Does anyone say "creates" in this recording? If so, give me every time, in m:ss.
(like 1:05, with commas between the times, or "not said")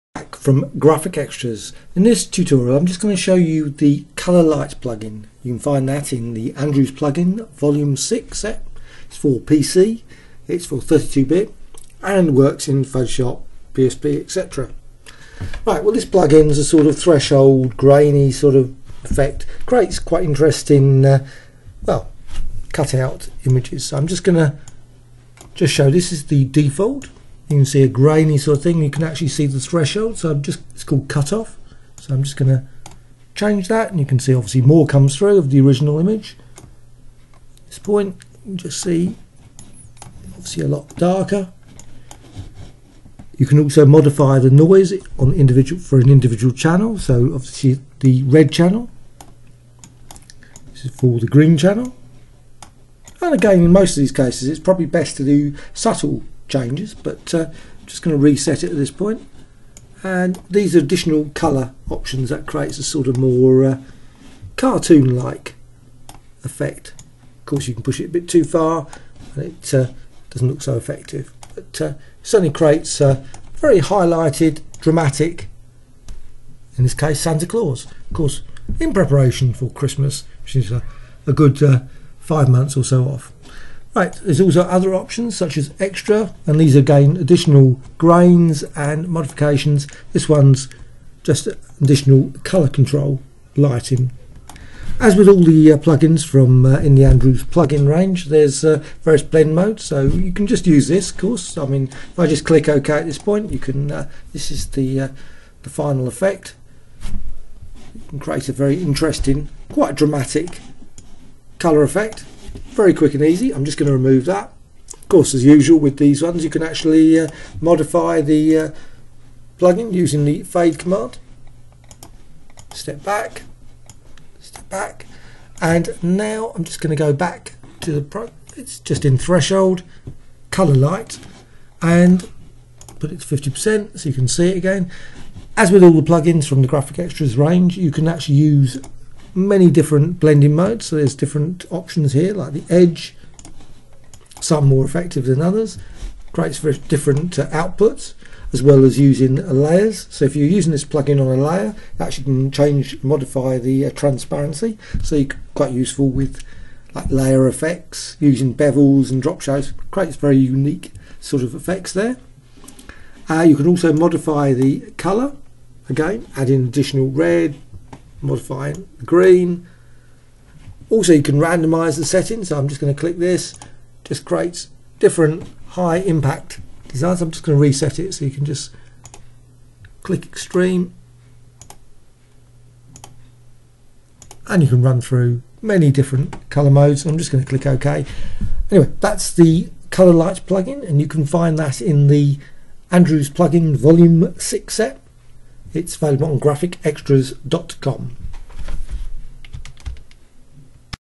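0:19, 1:02, 1:12, 1:48, 2:26, 2:39, 2:54.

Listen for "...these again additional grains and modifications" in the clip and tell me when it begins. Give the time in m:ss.
1:26.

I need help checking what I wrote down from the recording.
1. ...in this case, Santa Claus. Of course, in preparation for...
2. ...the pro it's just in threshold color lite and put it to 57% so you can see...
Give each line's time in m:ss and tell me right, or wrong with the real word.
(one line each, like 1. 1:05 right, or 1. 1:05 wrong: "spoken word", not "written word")
1. 1:16 right
2. 2:07 wrong: "50", not "57".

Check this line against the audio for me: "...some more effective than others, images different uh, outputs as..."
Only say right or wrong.
wrong.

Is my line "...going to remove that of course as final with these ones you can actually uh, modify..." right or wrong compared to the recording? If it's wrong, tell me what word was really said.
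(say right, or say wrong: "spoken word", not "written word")
wrong: "usual", not "final".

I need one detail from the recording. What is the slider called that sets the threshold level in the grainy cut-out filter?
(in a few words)
cutoff.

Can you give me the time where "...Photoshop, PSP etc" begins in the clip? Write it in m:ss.
0:12.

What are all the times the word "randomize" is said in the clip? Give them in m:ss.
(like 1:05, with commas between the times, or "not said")
2:51.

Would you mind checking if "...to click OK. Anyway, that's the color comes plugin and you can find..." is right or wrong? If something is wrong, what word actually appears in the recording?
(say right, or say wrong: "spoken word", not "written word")
wrong: "lites", not "comes".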